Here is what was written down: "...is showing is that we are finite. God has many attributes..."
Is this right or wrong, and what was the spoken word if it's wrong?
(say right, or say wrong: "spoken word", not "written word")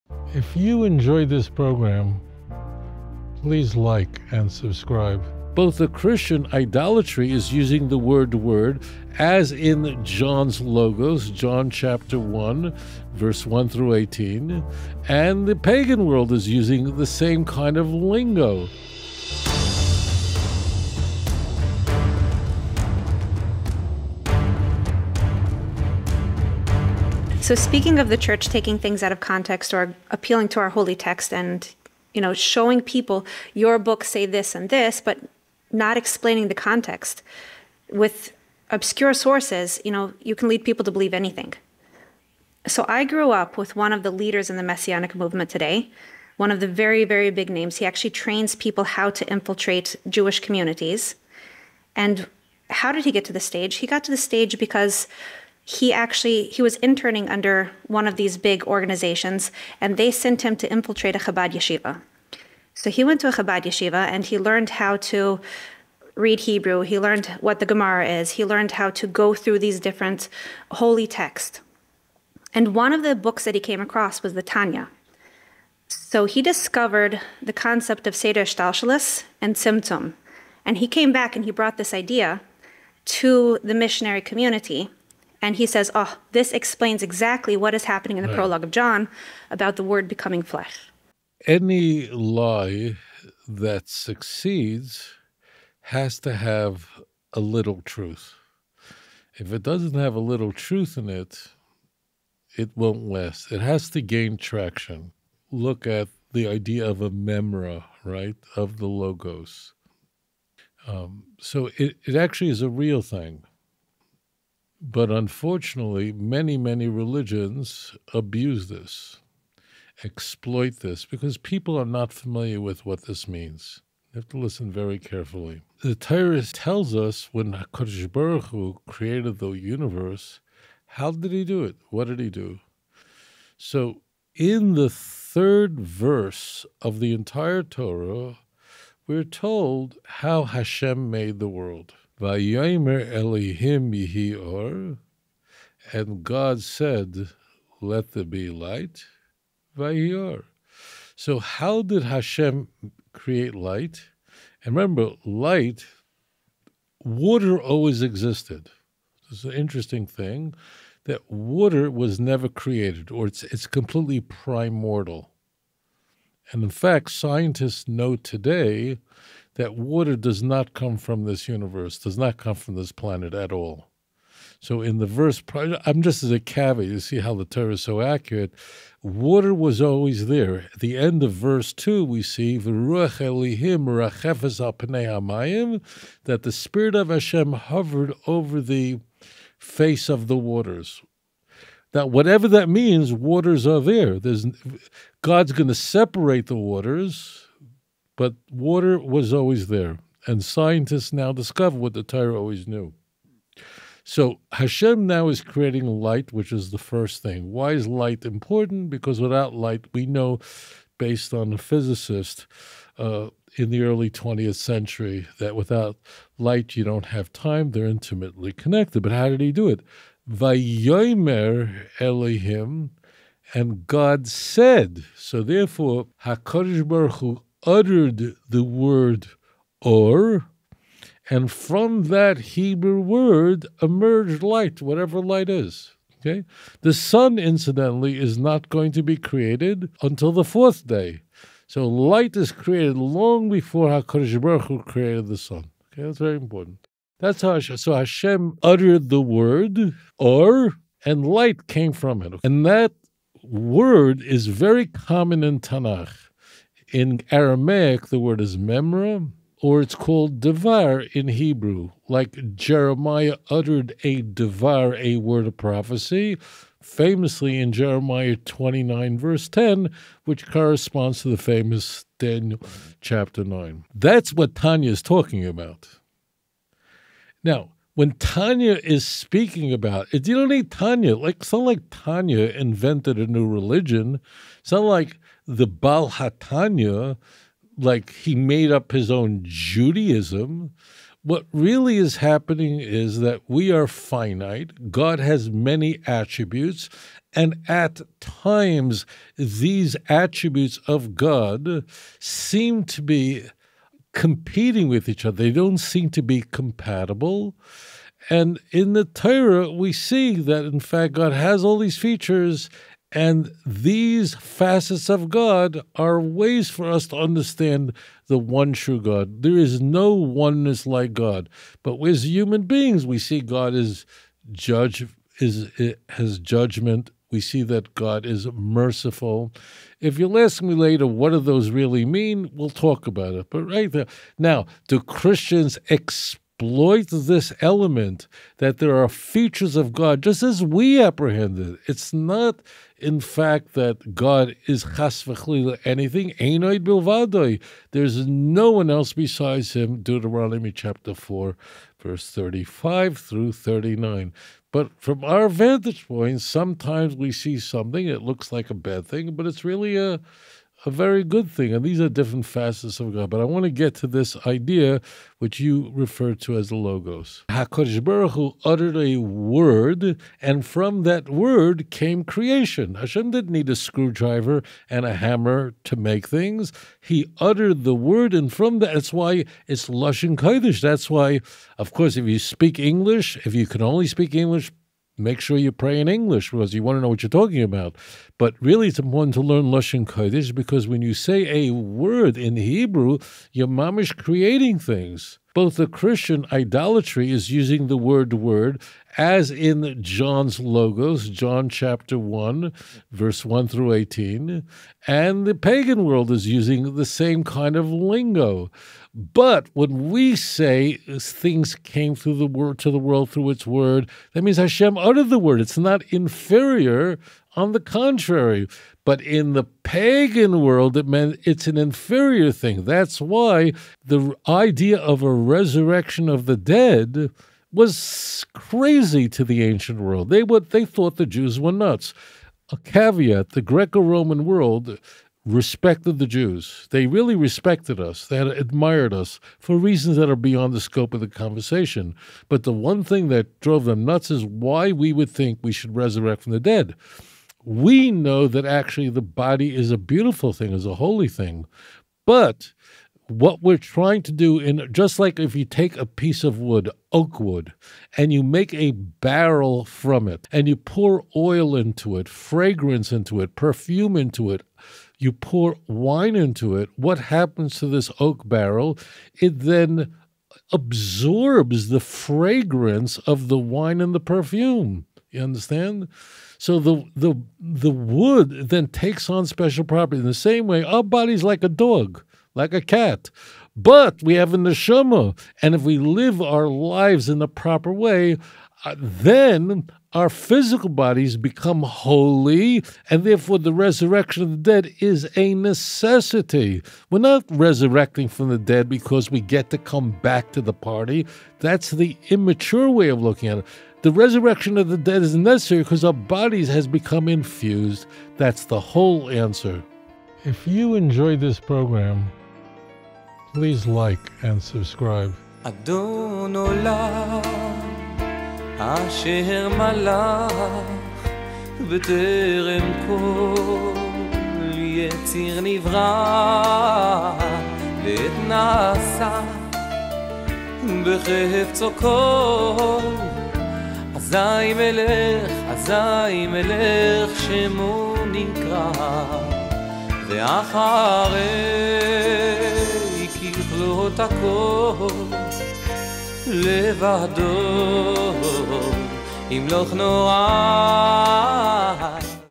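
wrong: "happening", not "showing".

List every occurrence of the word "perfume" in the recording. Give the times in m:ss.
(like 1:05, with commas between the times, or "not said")
7:43, 7:54.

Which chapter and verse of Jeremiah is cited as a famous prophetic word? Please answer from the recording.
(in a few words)
Jeremiah 29:10.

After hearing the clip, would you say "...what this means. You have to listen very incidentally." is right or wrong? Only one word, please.
wrong.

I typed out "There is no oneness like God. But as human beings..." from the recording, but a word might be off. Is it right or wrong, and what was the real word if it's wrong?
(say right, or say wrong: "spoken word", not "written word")
right.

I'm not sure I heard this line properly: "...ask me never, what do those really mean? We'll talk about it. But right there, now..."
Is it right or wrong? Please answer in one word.
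wrong.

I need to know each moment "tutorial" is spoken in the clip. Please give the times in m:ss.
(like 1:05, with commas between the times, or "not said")
not said.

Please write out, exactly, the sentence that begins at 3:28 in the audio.
Because without light, we know, based on a physicist uh, in the early 20th century, that without light, you don't have time.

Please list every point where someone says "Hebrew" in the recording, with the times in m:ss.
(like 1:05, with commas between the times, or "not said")
1:06, 3:52, 4:21, 6:32.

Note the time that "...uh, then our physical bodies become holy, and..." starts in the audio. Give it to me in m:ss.
8:08.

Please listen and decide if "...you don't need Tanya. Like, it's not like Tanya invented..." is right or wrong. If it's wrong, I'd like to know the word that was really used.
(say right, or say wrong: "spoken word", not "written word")
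right.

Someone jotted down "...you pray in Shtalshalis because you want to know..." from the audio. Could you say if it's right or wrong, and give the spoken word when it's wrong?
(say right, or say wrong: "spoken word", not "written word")
wrong: "English", not "Shtalshalis".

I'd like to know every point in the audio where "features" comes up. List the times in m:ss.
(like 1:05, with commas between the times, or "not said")
5:11, 5:39.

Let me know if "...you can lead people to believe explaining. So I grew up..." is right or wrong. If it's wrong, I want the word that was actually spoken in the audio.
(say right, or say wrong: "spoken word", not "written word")
wrong: "anything", not "explaining".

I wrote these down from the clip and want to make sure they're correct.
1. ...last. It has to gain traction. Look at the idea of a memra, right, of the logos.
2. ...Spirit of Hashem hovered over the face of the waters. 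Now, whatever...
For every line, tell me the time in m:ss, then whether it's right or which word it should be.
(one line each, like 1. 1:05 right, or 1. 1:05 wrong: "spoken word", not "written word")
1. 1:43 right
2. 3:06 right.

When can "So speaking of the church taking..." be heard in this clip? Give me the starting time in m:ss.
0:27.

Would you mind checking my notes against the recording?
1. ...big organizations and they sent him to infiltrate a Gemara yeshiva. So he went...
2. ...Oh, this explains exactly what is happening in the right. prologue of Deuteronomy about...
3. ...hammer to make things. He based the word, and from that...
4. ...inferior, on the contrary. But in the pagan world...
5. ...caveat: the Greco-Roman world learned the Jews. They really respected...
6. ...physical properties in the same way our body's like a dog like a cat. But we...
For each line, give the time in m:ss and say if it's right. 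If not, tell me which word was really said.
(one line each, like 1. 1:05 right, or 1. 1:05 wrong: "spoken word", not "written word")
1. 0:58 wrong: "Chabad", not "Gemara"
2. 1:25 wrong: "John", not "Deuteronomy"
3. 6:15 wrong: "uttered", not "based"
4. 6:56 right
5. 7:12 wrong: "respected", not "learned"
6. 7:59 wrong: "special", not "physical".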